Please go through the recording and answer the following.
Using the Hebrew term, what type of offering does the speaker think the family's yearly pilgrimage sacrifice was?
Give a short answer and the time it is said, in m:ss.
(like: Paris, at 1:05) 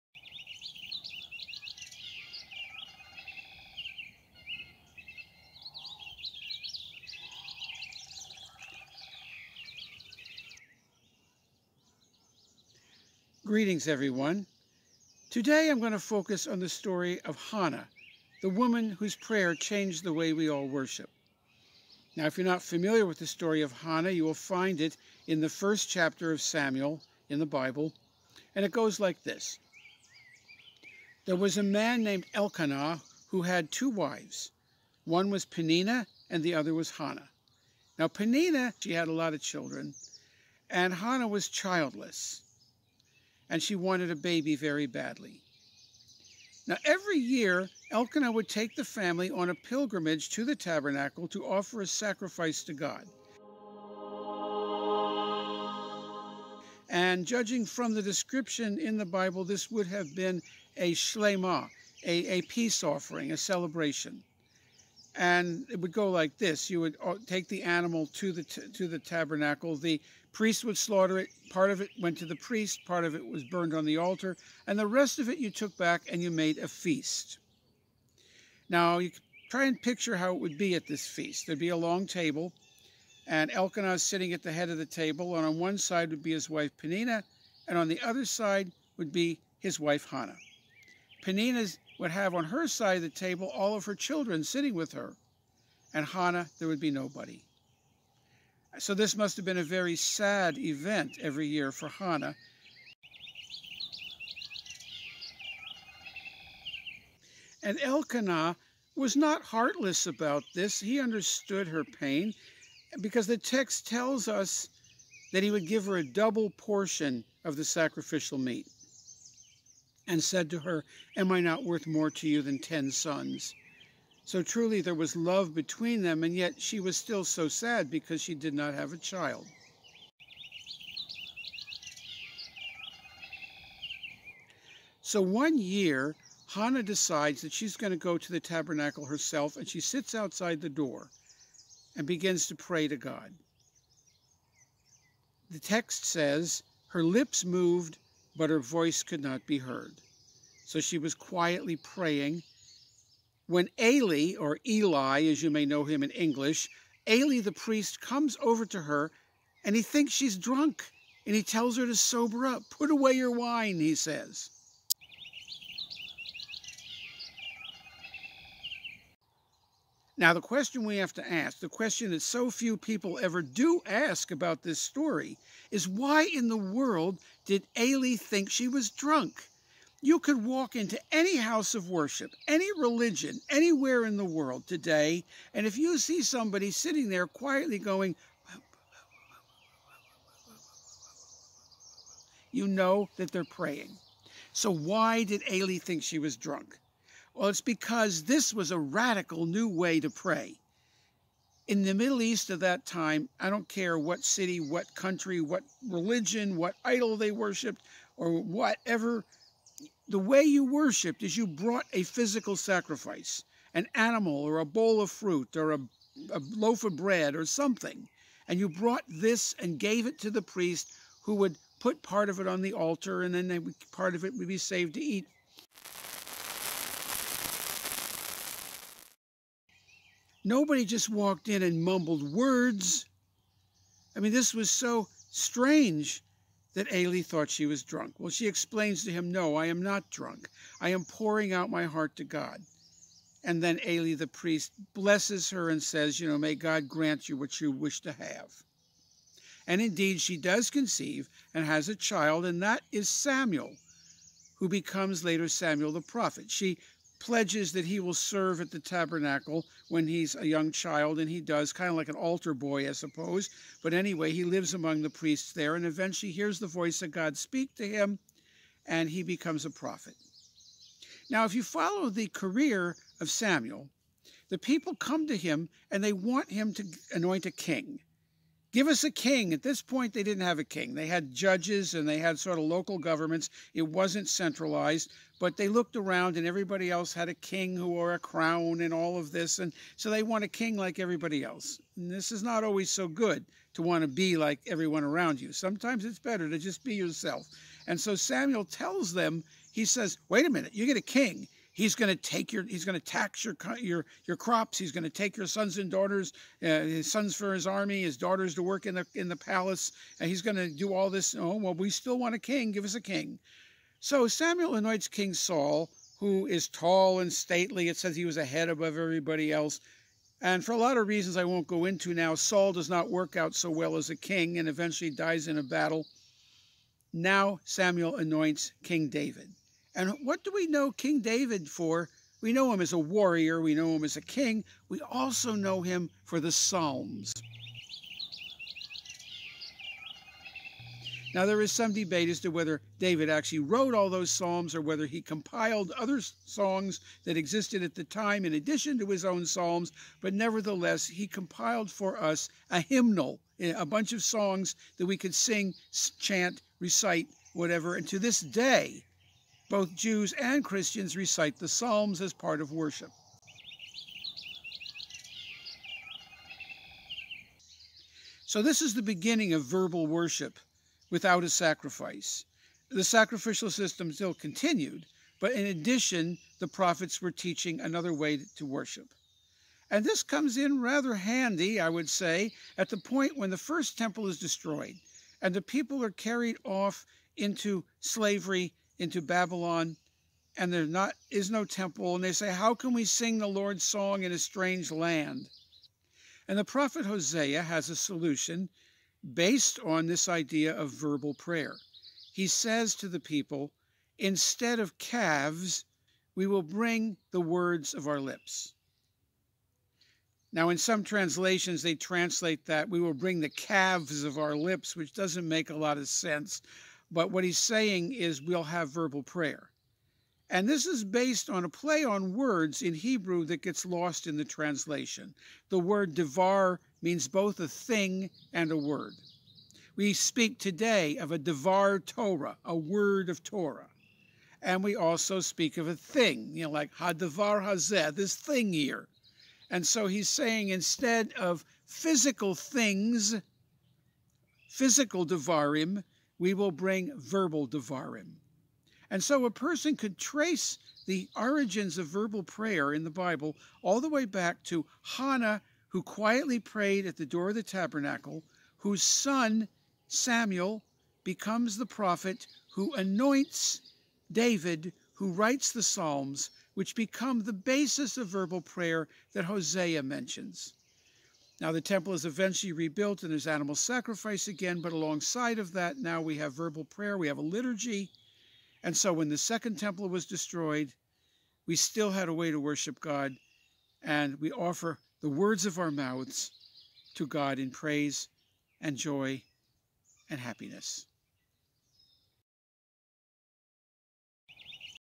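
shlema, at 1:00.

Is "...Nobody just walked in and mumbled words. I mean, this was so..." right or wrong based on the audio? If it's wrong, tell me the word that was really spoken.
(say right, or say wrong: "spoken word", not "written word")
right.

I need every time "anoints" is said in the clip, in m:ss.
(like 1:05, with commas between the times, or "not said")
4:37, 5:14, 5:28, 7:42.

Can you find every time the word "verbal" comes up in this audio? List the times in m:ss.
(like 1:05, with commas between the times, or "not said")
6:09, 6:40, 6:58, 7:27, 7:32, 7:48, 7:56.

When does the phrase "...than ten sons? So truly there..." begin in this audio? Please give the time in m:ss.
2:02.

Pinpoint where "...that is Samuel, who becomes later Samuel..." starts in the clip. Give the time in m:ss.
4:12.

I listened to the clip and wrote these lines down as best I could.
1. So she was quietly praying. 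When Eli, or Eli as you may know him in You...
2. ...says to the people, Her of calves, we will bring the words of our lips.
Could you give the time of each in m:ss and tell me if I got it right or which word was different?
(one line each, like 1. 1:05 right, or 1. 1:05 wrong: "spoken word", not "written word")
1. 2:30 wrong: "English", not "You"
2. 6:42 wrong: "Instead", not "Her".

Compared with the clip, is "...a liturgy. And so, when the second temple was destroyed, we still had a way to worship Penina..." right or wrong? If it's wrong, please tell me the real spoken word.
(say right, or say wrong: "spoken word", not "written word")
wrong: "God", not "Penina".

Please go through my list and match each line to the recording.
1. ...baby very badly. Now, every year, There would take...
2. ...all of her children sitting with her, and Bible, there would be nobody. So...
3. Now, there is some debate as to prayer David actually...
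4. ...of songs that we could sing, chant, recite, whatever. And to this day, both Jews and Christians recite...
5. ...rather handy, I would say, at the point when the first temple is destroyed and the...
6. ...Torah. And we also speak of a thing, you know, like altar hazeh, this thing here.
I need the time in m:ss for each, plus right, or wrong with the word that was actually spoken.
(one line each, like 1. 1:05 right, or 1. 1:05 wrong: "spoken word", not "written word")
1. 0:44 wrong: "Elkanah", not "There"
2. 1:33 wrong: "Hannah", not "Bible"
3. 5:41 wrong: "whether", not "prayer"
4. 5:54 right
5. 6:20 right
6. 7:13 wrong: "hadavar", not "altar".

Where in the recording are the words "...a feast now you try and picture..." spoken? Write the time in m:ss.
1:16.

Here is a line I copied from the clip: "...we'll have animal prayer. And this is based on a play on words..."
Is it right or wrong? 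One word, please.
wrong.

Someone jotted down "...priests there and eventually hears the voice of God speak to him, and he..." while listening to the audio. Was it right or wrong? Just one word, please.
right.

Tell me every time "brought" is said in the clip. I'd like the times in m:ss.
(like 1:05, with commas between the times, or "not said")
3:31, 3:38.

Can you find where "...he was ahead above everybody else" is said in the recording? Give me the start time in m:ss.
5:18.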